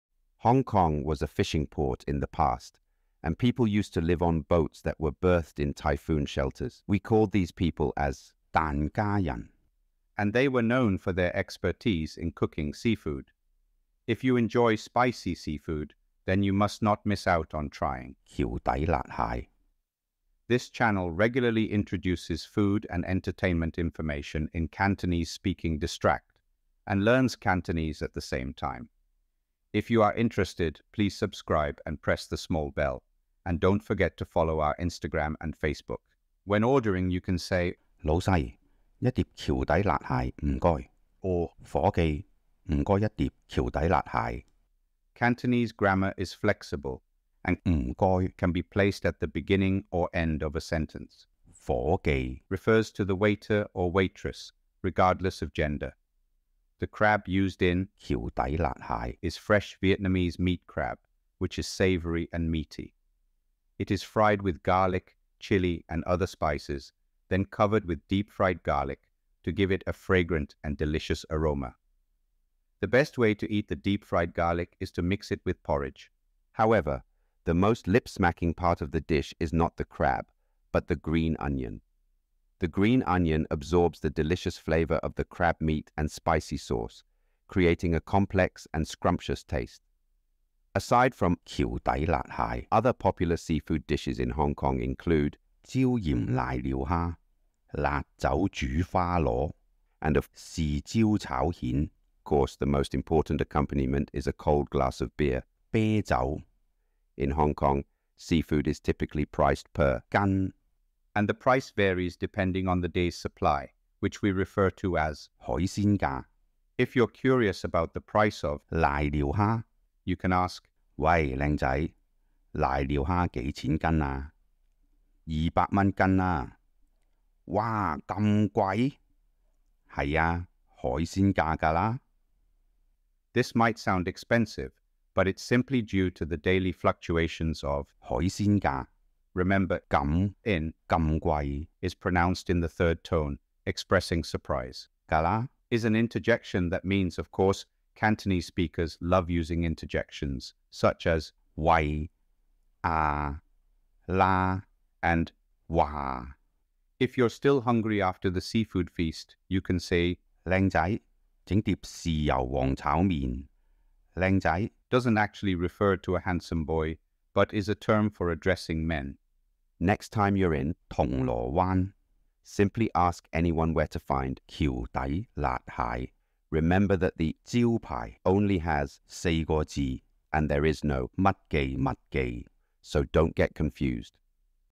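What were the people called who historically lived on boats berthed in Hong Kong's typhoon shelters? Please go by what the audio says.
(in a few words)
Dan Kayan.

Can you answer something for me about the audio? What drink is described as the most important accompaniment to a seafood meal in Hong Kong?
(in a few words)
Cold glass of beer.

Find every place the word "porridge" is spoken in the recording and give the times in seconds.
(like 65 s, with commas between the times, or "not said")
75 s.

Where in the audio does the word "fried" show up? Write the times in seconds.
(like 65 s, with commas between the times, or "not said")
64 s, 68 s, 74 s.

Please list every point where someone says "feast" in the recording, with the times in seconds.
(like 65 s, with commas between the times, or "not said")
158 s.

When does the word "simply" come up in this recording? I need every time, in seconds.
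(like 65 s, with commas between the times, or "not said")
135 s, 172 s.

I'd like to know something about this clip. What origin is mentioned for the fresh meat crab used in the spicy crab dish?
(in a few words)
Vietnamese.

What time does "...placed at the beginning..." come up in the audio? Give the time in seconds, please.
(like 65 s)
48 s.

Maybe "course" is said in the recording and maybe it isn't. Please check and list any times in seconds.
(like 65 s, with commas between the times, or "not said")
102 s, 147 s.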